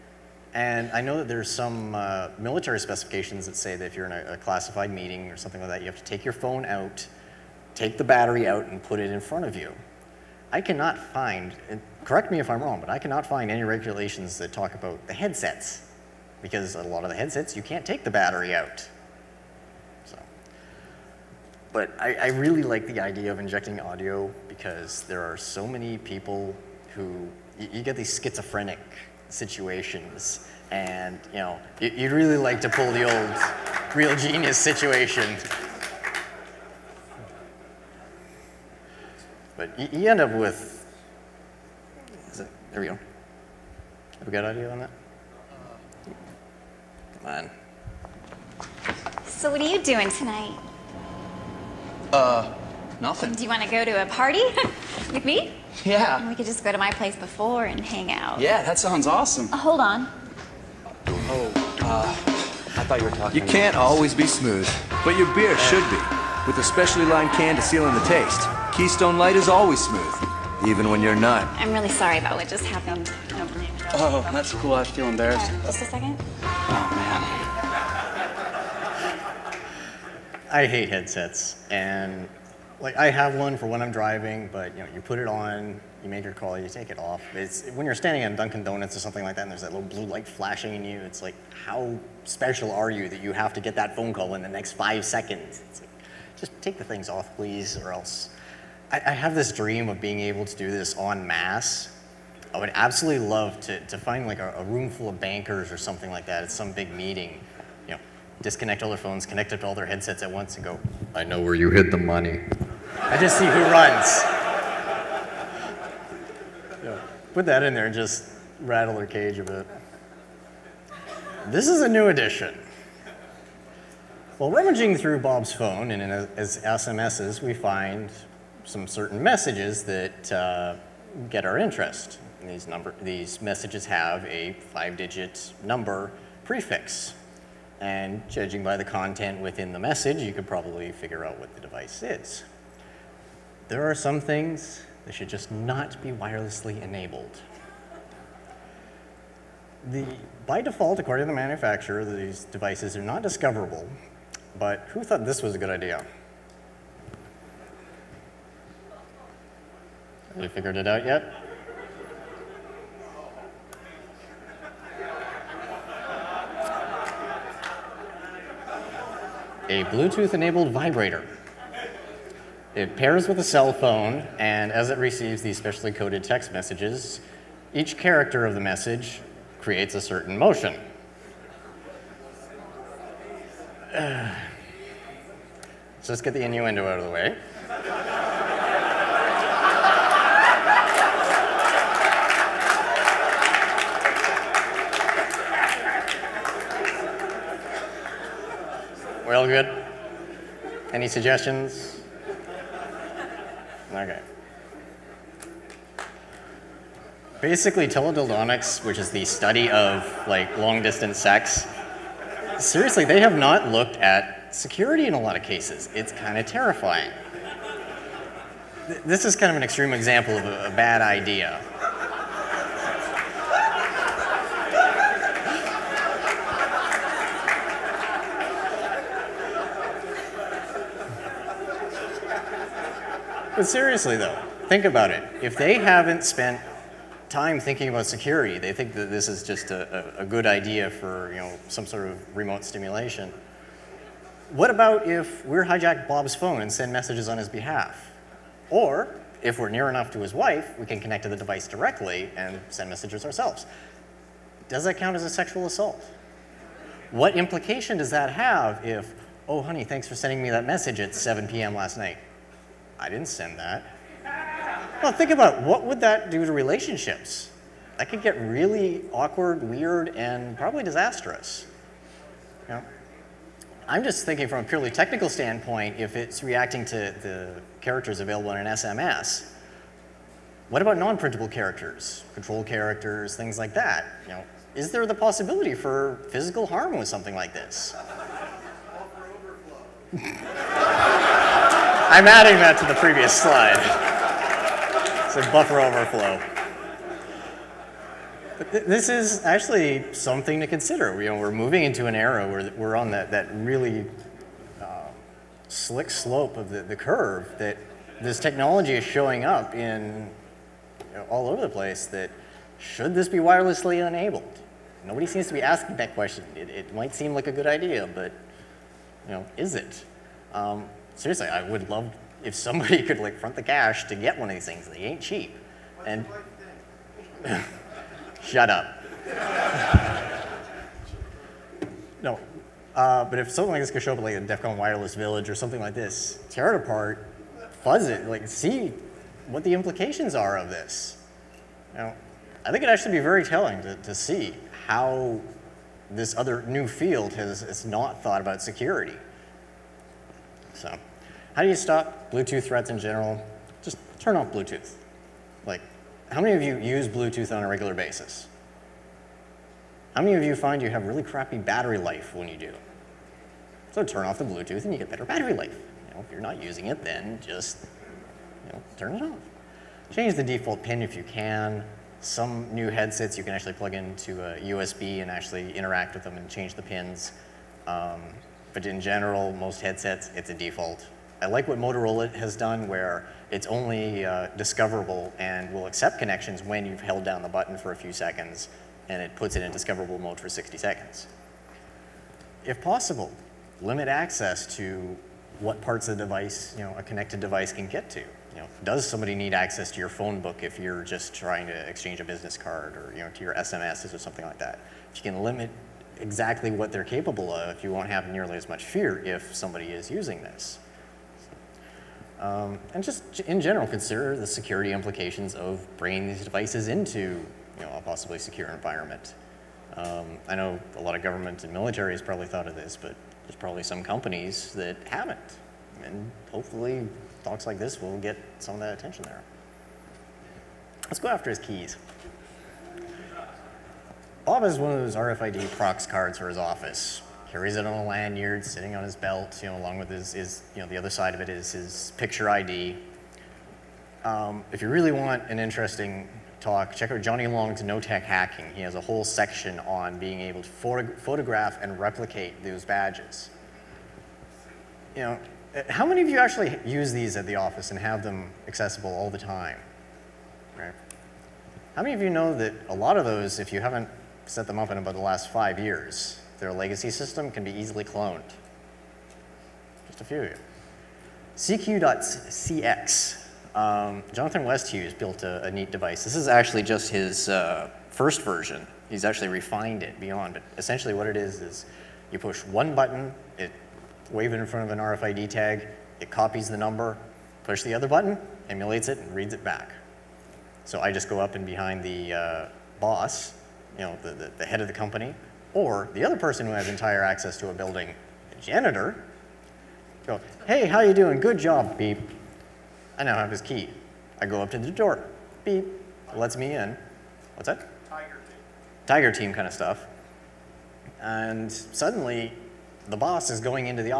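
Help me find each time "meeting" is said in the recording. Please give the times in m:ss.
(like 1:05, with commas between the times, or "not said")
0:04, 1:46.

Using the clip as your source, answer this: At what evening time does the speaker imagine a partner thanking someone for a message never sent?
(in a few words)
7 p.m.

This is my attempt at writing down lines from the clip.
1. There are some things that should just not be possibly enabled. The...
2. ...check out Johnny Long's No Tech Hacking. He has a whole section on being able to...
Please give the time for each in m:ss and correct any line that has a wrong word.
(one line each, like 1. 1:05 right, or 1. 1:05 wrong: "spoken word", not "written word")
1. 2:23 wrong: "wirelessly", not "possibly"
2. 7:26 right.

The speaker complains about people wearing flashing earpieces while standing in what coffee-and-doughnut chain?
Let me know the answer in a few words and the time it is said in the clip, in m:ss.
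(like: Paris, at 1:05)
Dunkin' Donuts, at 1:28.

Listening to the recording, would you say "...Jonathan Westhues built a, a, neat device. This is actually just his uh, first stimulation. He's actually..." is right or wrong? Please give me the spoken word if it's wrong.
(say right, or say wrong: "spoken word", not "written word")
wrong: "version", not "stimulation".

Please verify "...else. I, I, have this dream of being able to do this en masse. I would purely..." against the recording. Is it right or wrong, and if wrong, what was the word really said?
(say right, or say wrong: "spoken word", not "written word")
wrong: "absolutely", not "purely".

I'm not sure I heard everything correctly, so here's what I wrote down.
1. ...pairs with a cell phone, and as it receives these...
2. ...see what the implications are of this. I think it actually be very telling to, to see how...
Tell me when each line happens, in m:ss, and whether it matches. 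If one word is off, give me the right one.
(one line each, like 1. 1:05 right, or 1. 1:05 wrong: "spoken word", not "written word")
1. 2:52 right
2. 5:38 right.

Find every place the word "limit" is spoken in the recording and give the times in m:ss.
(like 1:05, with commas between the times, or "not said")
6:33, 6:45.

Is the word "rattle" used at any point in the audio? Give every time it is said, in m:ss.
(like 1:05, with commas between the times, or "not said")
1:58.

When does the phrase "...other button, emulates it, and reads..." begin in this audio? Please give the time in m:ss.
8:07.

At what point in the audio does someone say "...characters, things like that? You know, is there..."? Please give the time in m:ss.
4:42.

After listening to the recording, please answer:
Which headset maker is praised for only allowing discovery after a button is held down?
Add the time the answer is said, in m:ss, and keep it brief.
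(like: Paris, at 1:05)
Motorola, at 6:21.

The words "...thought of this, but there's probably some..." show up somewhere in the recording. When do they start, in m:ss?
7:02.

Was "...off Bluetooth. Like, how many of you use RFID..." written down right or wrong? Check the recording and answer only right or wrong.
wrong.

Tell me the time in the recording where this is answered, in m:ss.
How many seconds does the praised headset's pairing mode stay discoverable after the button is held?
6:30.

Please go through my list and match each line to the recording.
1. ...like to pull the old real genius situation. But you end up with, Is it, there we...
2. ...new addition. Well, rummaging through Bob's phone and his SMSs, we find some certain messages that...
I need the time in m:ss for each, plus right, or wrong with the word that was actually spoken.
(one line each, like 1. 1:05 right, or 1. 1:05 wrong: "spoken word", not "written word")
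1. 0:32 right
2. 2:01 right.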